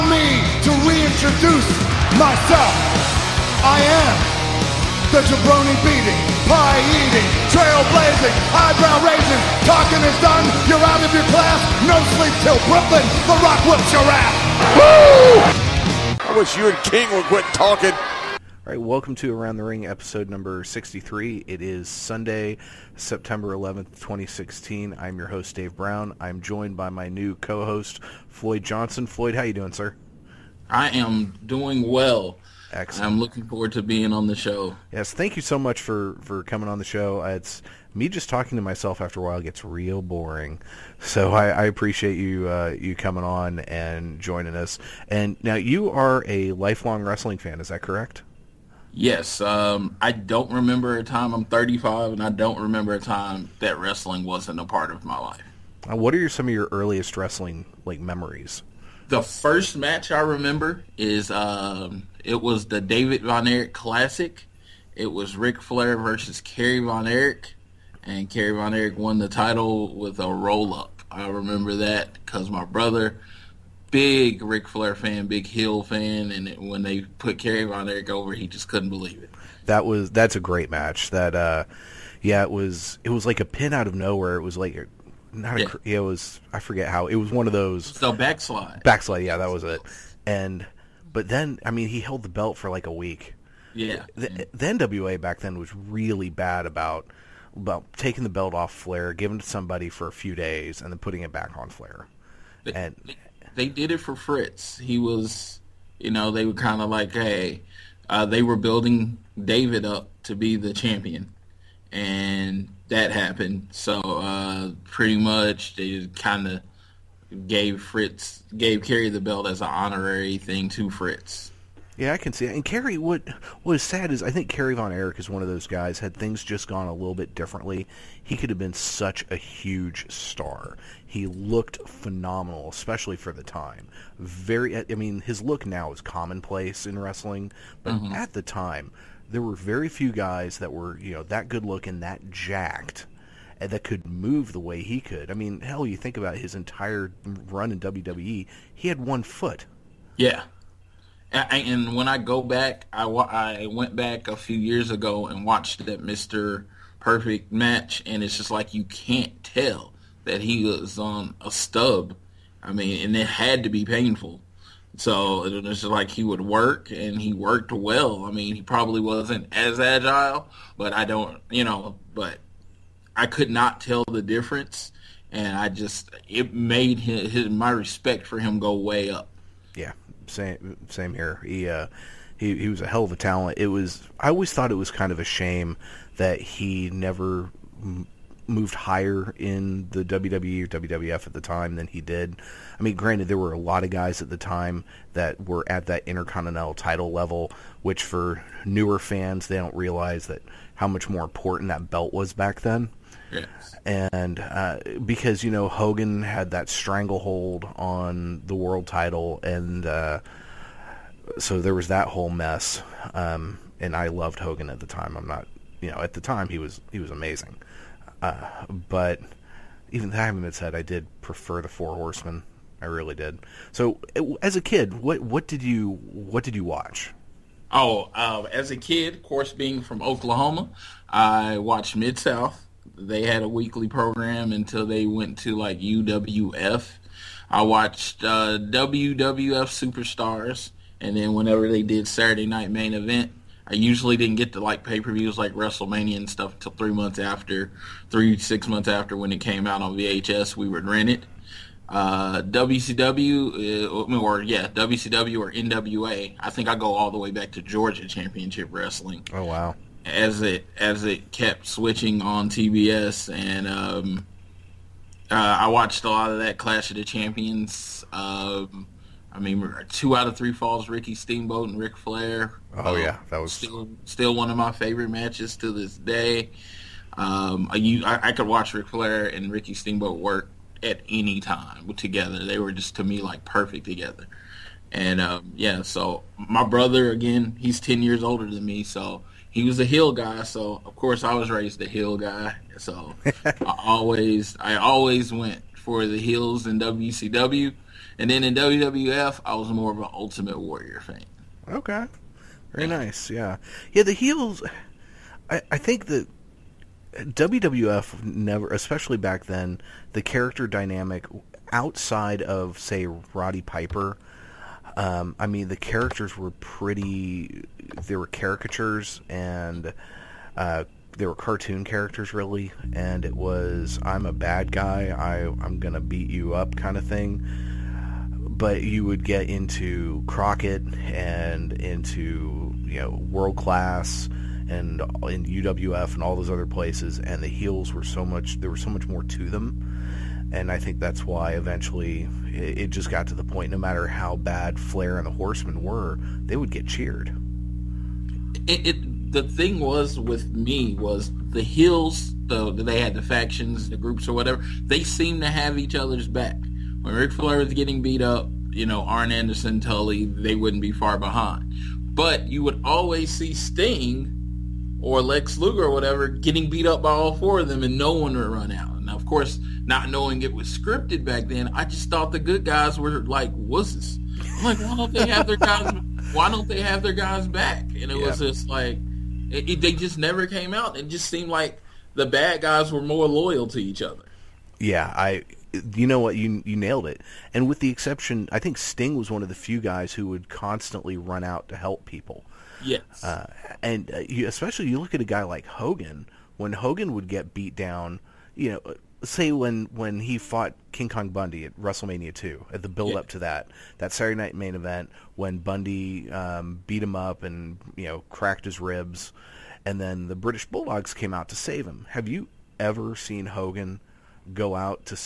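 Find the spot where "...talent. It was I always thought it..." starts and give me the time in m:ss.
3:03.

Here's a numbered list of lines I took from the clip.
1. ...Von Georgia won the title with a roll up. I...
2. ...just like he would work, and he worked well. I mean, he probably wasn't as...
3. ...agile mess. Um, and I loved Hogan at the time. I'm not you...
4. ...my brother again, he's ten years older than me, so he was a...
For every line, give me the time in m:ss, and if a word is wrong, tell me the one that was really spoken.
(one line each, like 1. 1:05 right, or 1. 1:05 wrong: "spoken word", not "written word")
1. 1:08 wrong: "Erich", not "Georgia"
2. 2:45 right
3. 3:32 wrong: "whole", not "agile"
4. 4:46 right.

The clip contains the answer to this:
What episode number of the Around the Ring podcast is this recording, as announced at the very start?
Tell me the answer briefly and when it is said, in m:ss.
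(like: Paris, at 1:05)
63, at 0:19.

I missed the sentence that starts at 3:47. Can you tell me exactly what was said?
Oh, uh, as a kid, of course, being from Oklahoma, I watched Mid South.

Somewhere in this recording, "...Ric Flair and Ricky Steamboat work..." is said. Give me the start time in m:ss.
4:38.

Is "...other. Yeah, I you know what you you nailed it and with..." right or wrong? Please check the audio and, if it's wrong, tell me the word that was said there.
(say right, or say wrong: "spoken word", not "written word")
right.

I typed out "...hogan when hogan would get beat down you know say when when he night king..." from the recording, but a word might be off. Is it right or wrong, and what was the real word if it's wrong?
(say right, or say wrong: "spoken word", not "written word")
wrong: "fought", not "night".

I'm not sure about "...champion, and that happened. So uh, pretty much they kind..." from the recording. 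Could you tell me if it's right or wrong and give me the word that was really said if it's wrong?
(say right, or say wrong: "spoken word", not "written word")
right.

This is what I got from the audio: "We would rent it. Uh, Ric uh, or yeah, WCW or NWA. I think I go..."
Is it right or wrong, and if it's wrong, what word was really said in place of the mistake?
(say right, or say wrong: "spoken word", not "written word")
wrong: "WCW", not "Ric".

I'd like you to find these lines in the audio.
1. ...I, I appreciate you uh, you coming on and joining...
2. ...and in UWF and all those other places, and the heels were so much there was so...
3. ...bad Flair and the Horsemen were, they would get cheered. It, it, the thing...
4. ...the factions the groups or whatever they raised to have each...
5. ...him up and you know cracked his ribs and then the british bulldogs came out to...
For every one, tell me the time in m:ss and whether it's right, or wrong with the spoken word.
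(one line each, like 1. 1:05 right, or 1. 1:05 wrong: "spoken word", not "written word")
1. 0:41 right
2. 5:34 right
3. 5:44 right
4. 5:53 wrong: "seemed", not "raised"
5. 6:47 right.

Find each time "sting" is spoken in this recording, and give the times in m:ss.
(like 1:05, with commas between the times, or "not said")
6:03, 6:28.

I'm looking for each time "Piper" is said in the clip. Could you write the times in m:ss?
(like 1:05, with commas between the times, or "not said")
5:13.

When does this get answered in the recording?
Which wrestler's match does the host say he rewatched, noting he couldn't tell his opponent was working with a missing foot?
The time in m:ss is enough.
2:36.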